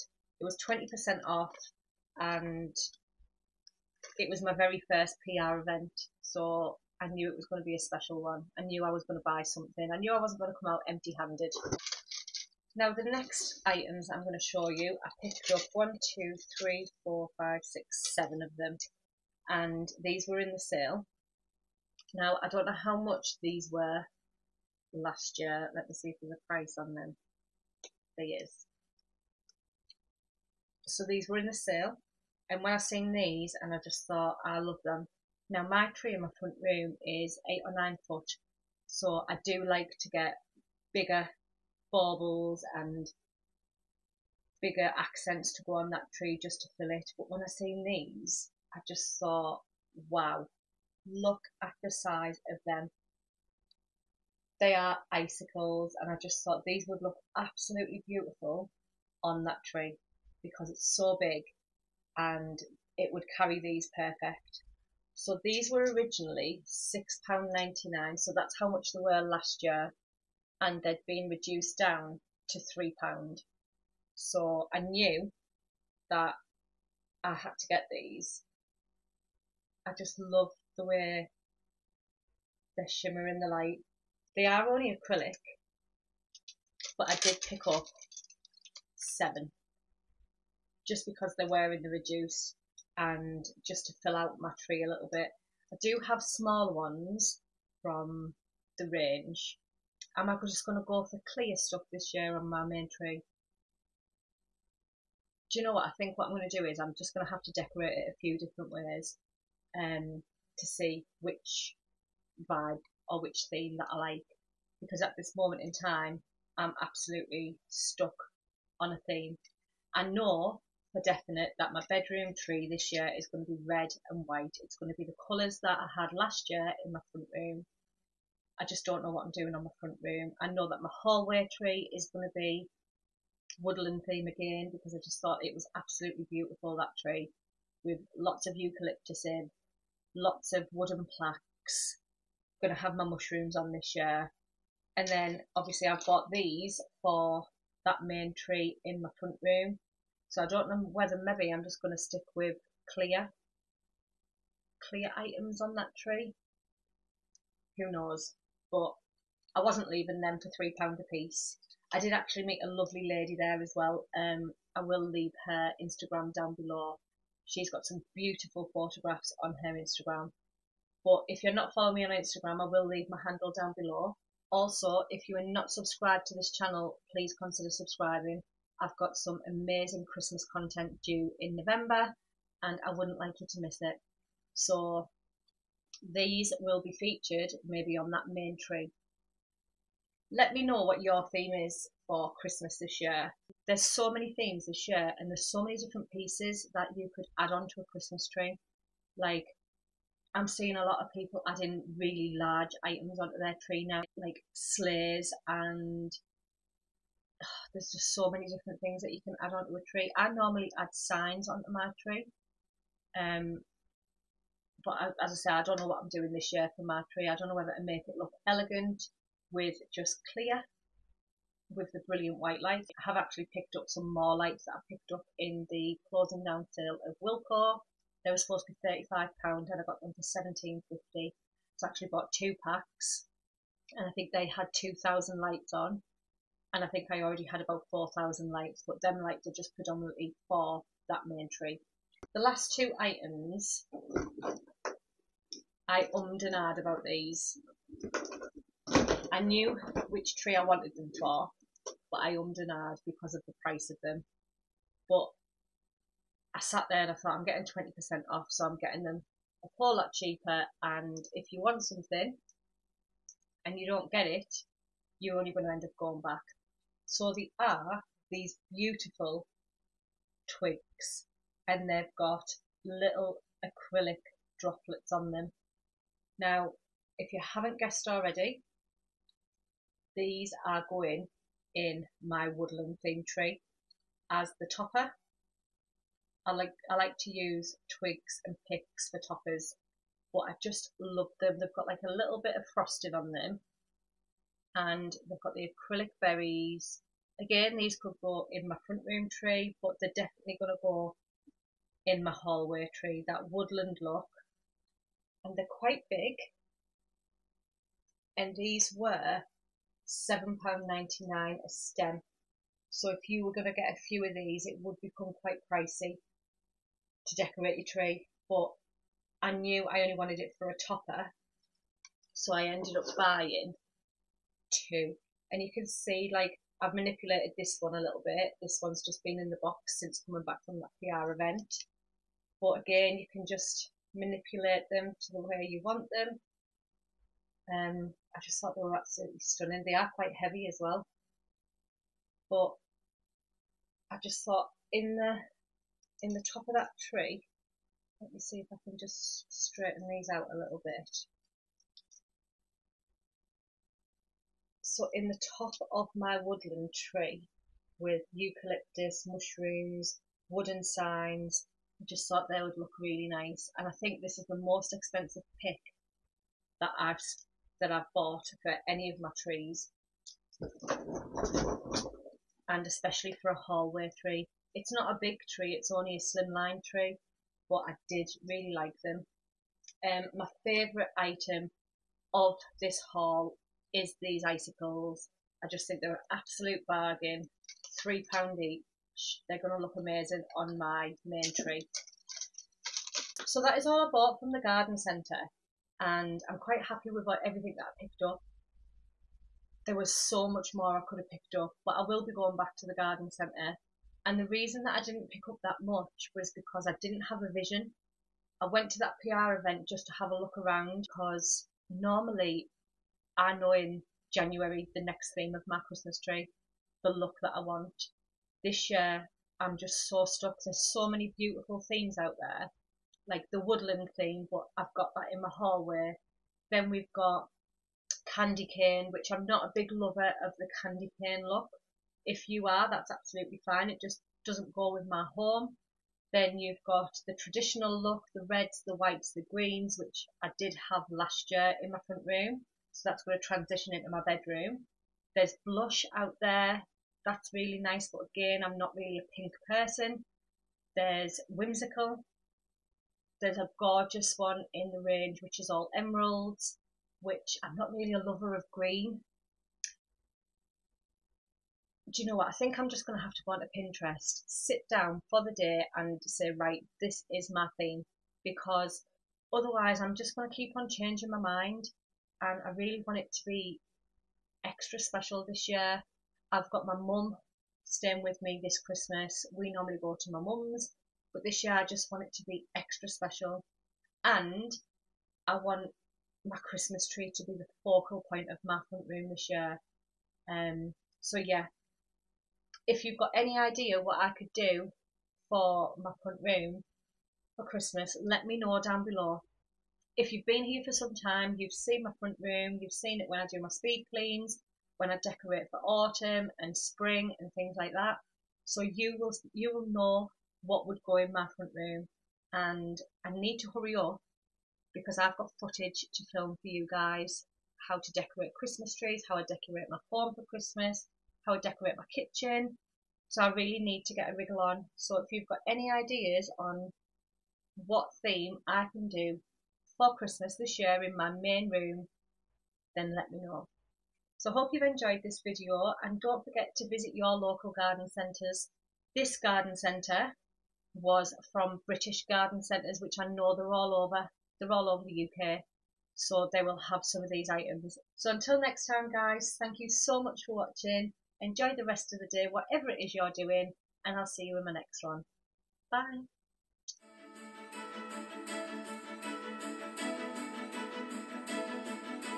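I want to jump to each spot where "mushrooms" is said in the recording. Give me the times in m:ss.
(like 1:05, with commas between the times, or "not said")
2:23, 5:59.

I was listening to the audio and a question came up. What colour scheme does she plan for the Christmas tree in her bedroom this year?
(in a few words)
Red and white.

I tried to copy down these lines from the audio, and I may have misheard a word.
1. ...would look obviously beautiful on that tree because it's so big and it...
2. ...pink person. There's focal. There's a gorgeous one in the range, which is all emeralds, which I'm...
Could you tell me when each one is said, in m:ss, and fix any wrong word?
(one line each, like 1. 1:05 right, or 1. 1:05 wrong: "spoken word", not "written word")
1. 0:56 wrong: "absolutely", not "obviously"
2. 7:29 wrong: "whimsical", not "focal".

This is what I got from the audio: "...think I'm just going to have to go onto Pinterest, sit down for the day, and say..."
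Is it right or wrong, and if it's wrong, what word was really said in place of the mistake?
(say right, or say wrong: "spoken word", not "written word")
right.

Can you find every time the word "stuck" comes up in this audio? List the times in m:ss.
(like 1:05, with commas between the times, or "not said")
1:57, 7:00.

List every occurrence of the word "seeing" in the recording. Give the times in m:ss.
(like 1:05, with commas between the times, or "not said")
3:20.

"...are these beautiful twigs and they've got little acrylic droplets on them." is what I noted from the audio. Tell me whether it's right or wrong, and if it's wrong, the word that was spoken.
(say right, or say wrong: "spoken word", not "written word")
right.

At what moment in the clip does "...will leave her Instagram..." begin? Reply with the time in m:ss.
2:44.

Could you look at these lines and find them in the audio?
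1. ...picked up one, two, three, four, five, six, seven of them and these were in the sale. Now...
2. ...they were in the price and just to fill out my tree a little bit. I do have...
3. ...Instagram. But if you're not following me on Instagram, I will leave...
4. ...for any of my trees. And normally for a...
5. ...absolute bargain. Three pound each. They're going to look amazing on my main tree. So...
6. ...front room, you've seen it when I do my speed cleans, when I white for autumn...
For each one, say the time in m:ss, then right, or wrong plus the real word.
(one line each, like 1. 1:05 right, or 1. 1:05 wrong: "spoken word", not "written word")
1. 0:15 right
2. 1:31 wrong: "reduce", not "price"
3. 2:49 right
4. 6:08 wrong: "especially", not "normally"
5. 6:26 right
6. 8:22 wrong: "decorate", not "white".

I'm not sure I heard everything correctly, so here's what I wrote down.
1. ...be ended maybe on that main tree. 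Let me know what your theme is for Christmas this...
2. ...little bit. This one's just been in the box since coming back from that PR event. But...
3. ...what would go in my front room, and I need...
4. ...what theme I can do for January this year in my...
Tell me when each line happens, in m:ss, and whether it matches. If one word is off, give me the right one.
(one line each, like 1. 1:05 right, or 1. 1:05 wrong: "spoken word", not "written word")
1. 3:06 wrong: "featured", not "ended"
2. 5:28 right
3. 8:30 right
4. 8:47 wrong: "Christmas", not "January".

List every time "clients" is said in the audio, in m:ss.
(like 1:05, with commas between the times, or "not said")
not said.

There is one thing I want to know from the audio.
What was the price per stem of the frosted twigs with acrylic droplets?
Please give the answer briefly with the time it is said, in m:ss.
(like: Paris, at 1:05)
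£7.99, at 5:10.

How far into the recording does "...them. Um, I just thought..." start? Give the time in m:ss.
5:36.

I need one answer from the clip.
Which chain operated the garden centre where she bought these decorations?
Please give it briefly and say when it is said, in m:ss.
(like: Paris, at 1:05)
British Garden Centres, at 9:01.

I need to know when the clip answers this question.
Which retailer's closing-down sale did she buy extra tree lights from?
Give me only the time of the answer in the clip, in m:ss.
3:47.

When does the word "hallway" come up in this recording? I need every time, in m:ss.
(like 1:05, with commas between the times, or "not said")
2:11, 5:02, 6:13, 7:05.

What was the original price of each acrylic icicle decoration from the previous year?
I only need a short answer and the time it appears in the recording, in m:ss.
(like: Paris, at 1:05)
£6.99, at 1:06.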